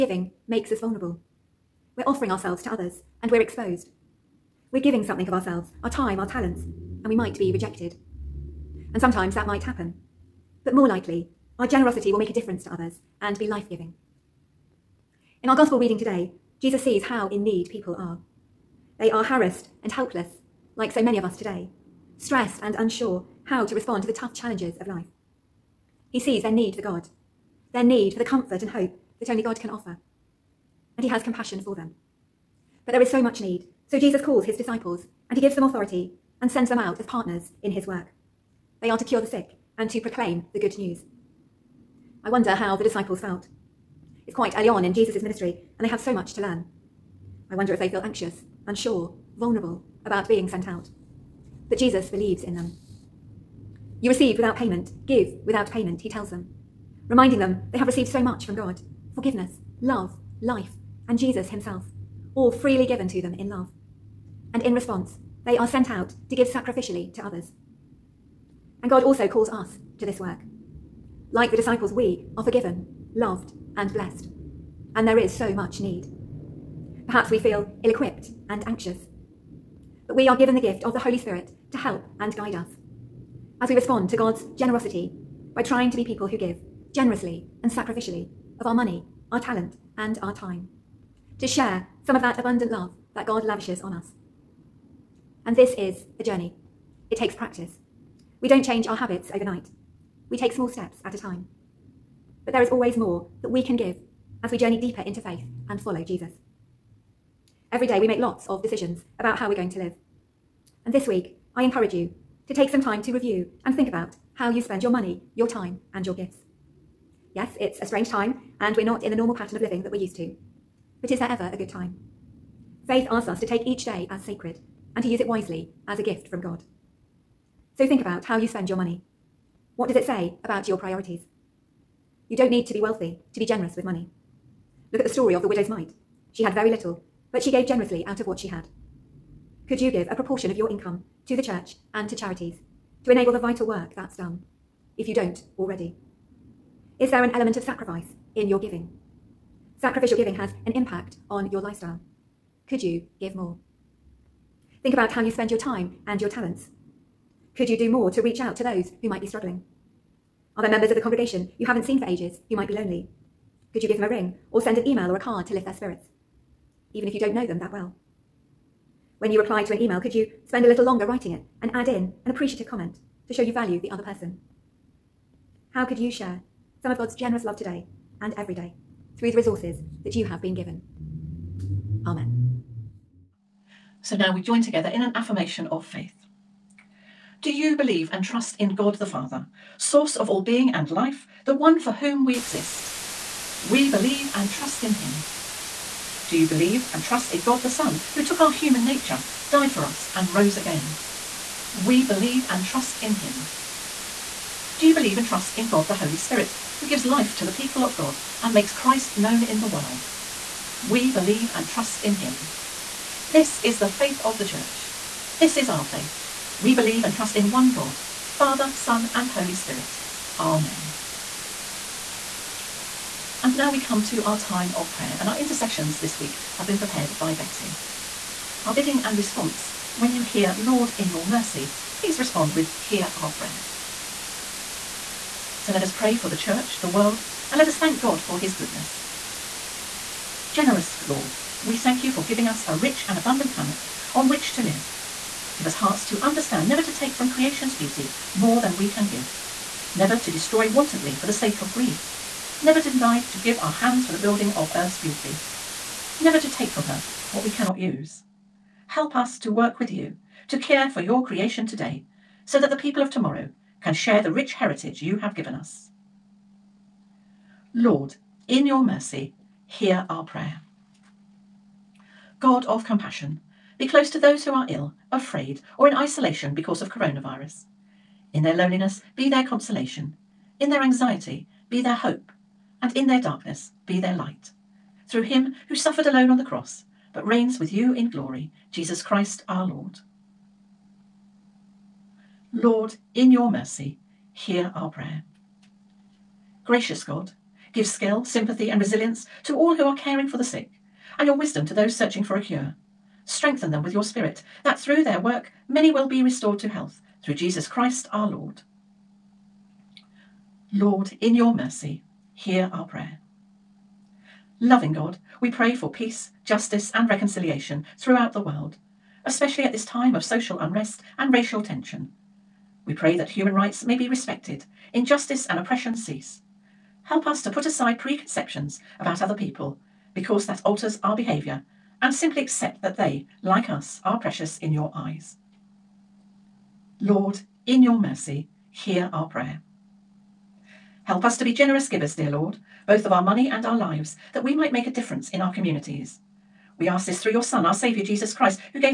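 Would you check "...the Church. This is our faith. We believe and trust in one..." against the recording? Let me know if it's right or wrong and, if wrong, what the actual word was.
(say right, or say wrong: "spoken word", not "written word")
right.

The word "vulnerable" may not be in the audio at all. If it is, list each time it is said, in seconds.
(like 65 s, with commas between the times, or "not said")
0 s, 49 s.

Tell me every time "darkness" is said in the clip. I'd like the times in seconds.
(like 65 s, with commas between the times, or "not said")
283 s.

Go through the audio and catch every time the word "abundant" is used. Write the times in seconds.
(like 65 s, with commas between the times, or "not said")
92 s, 243 s.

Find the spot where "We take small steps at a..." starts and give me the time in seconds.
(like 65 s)
100 s.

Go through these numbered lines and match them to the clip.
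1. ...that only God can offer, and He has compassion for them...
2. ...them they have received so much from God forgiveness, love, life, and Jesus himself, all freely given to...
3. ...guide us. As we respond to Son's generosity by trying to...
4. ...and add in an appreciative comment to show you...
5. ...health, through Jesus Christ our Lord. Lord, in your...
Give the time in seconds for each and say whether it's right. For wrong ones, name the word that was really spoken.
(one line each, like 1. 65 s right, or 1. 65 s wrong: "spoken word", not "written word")
1. 29 s right
2. 57 s right
3. 82 s wrong: "God", not "Son"
4. 171 s right
5. 306 s right.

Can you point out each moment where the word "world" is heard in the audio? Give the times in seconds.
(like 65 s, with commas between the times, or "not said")
209 s, 236 s, 318 s.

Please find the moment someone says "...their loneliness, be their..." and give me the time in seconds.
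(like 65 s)
278 s.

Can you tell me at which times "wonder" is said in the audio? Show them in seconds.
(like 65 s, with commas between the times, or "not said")
42 s, 47 s.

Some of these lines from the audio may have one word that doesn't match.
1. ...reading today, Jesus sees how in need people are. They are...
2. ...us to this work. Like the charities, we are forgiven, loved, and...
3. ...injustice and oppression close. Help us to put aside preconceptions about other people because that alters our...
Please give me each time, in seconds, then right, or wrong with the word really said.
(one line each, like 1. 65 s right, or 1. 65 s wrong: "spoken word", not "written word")
1. 15 s right
2. 69 s wrong: "disciples", not "charities"
3. 324 s wrong: "cease", not "close".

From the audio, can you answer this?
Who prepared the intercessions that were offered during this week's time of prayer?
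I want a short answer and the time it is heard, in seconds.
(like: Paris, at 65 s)
Betty, at 227 s.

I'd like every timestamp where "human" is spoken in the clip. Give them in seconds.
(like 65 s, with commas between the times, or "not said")
198 s, 323 s.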